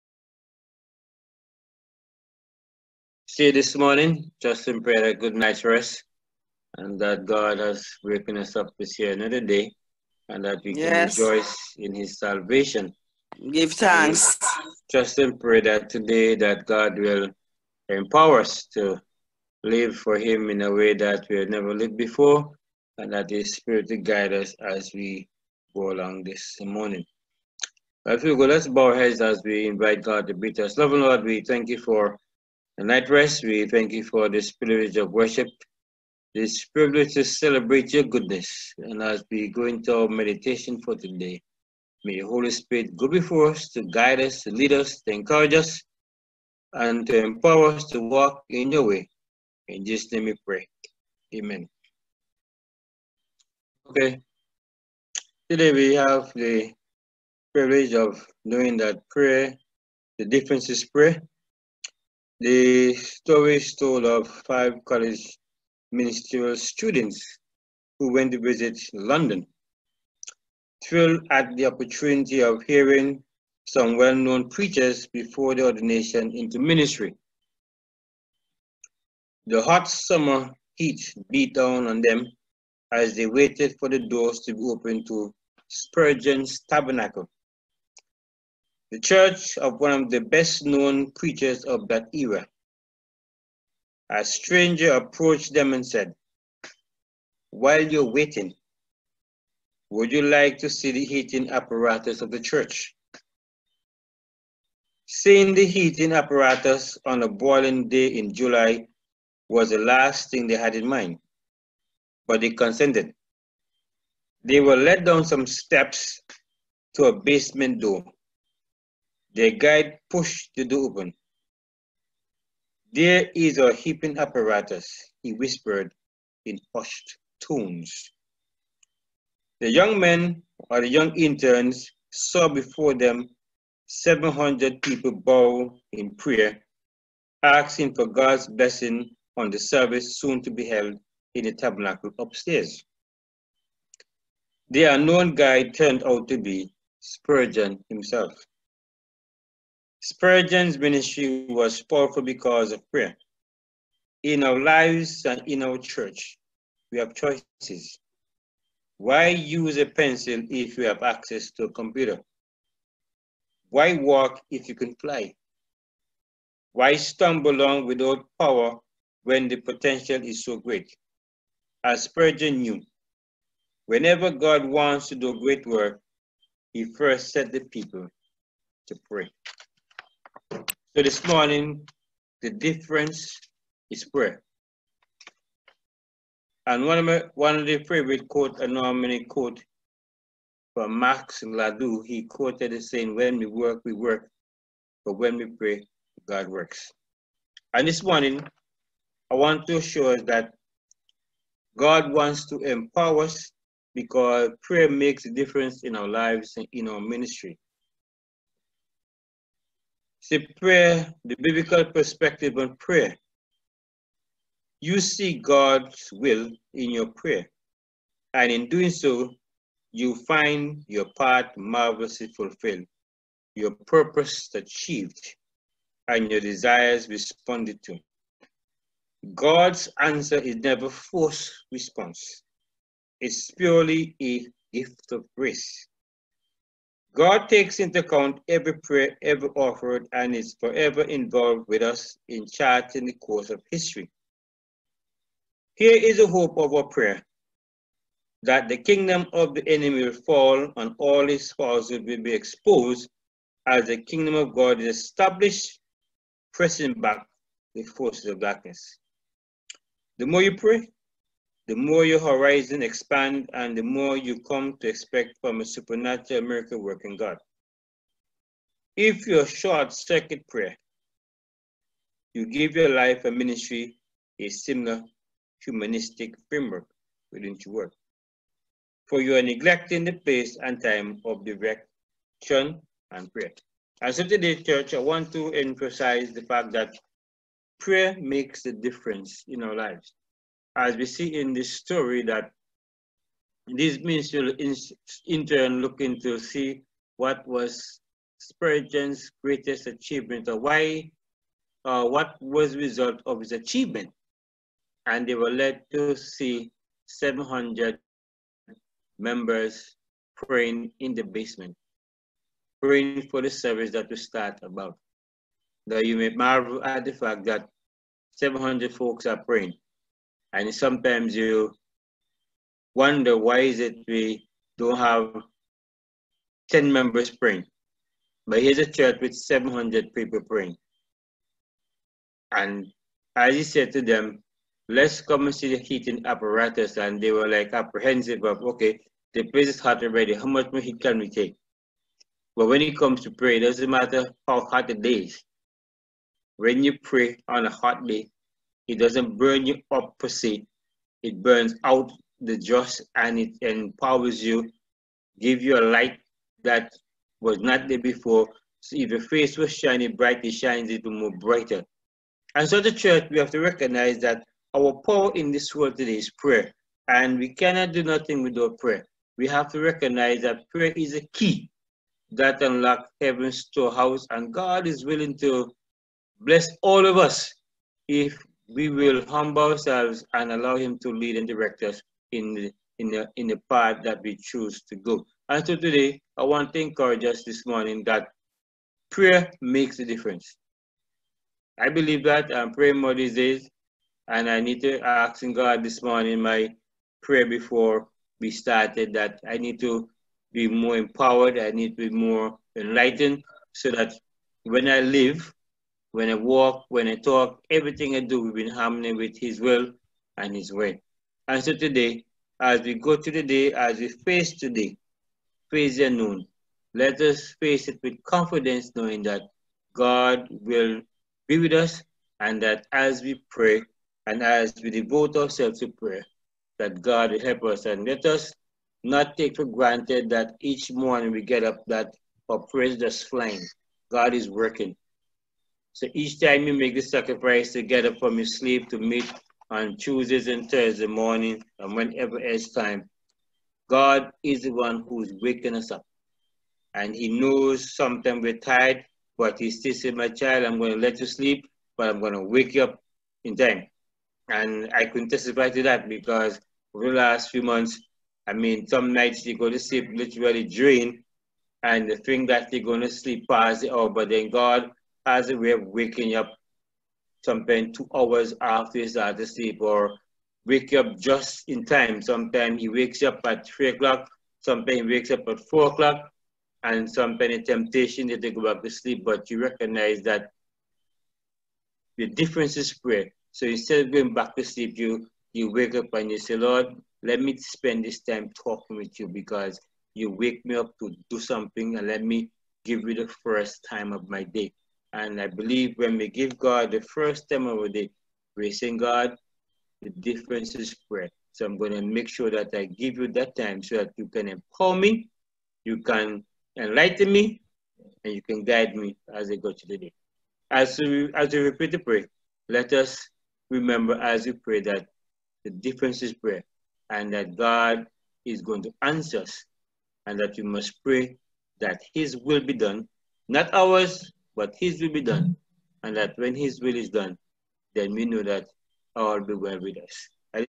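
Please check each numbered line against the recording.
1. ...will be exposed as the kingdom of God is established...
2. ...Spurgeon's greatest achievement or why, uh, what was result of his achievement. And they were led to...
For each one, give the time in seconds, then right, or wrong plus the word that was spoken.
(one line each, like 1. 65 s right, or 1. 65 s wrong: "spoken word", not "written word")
1. 252 s right
2. 298 s right.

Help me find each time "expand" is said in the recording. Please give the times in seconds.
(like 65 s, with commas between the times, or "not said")
262 s.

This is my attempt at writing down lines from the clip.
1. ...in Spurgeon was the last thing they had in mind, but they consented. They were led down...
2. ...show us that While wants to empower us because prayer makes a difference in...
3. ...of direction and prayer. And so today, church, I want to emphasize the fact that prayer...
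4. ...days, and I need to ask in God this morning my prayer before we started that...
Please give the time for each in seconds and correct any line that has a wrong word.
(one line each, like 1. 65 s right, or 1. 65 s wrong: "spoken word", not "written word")
1. 108 s wrong: "July", not "Spurgeon"
2. 199 s wrong: "God", not "While"
3. 281 s right
4. 393 s right.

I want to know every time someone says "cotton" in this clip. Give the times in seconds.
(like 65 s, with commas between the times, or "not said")
not said.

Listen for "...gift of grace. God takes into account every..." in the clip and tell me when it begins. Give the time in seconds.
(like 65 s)
234 s.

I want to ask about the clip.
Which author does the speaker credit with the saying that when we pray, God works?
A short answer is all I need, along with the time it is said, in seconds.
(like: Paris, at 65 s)
Max Lucado, at 190 s.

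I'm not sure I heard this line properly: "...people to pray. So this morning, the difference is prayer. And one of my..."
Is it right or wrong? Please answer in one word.
right.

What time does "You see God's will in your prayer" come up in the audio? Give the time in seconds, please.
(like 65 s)
214 s.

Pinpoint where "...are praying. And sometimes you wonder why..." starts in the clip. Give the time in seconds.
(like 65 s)
319 s.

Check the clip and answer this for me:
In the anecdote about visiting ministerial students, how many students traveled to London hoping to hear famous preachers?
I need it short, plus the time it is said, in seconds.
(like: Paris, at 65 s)
5, at 64 s.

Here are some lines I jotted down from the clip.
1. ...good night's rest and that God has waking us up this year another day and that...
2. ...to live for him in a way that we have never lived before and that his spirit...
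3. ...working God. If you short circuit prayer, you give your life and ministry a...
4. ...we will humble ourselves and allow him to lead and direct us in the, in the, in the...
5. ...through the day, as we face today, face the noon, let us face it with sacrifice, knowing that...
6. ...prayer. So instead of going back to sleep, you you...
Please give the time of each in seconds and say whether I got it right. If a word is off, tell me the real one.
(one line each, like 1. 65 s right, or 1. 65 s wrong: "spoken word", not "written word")
1. 5 s right
2. 18 s right
3. 266 s right
4. 378 s right
5. 413 s wrong: "confidence", not "sacrifice"
6. 482 s right.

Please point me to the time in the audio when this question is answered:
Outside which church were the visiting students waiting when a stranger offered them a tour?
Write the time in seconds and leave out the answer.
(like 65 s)
85 s.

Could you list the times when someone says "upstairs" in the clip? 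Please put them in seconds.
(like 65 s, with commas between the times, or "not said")
142 s.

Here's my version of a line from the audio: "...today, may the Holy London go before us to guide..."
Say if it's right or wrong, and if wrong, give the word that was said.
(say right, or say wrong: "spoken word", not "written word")
wrong: "Spirit", not "London".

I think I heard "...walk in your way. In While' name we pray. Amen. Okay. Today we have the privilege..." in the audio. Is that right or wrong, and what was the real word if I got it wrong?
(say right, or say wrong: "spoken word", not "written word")
wrong: "Jesus", not "While".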